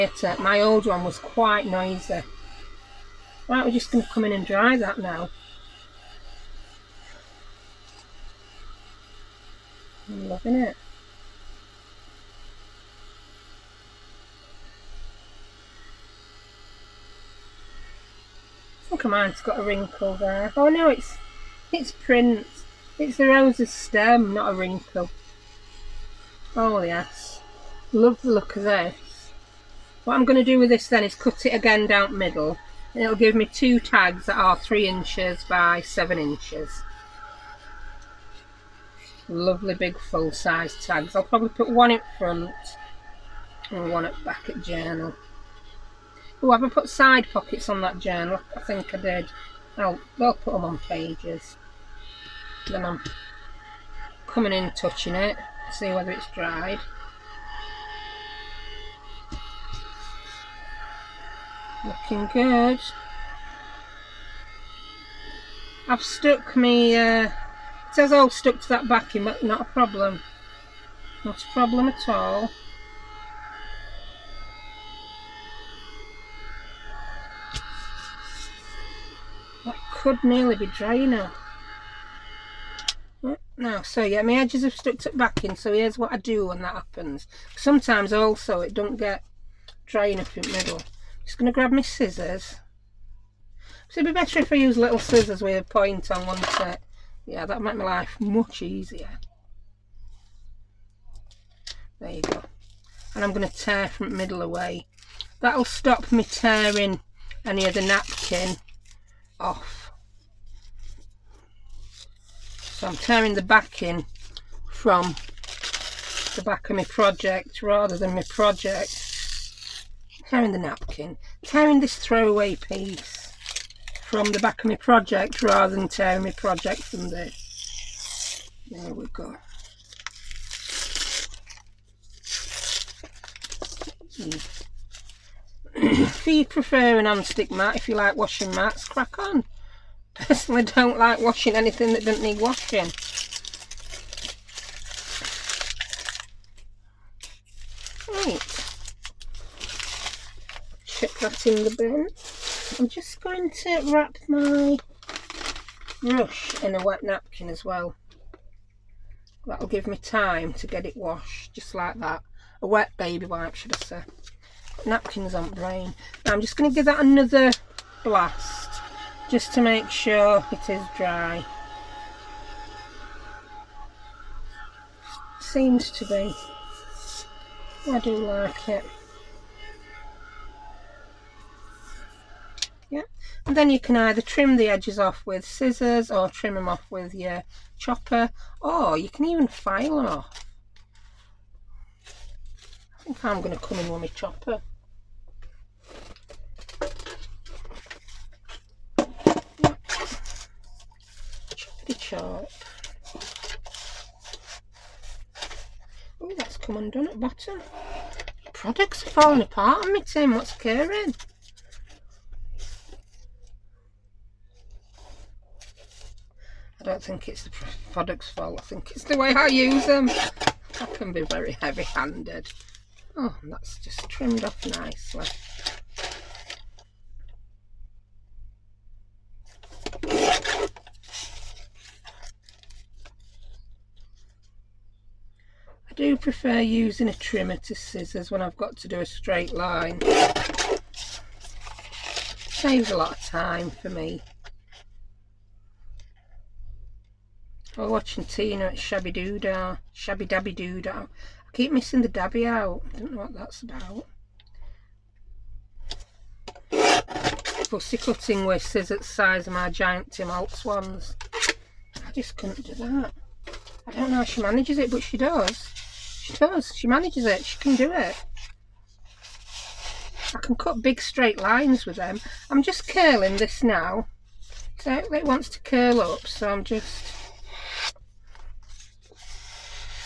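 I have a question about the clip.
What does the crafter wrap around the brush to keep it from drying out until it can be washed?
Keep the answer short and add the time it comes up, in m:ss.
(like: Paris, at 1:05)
a wet baby wipe, at 2:42.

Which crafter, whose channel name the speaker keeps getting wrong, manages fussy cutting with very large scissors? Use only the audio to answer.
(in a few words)
Tina.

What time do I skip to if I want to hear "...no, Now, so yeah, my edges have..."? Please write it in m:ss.
1:23.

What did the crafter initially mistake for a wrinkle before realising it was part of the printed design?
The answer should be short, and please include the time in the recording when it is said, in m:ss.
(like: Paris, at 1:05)
the rose's stem, at 0:23.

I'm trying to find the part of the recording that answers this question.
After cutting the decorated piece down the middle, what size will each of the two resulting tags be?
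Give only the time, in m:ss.
0:34.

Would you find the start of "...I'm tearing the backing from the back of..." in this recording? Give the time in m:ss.
1:52.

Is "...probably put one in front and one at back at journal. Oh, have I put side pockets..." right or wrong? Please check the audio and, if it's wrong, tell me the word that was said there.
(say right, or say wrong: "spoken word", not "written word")
right.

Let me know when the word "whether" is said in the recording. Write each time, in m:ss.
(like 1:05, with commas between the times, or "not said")
0:55.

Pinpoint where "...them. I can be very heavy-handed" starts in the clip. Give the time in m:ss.
3:39.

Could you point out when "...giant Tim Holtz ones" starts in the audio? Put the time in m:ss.
4:19.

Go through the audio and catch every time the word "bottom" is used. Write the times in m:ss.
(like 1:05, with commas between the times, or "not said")
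3:27.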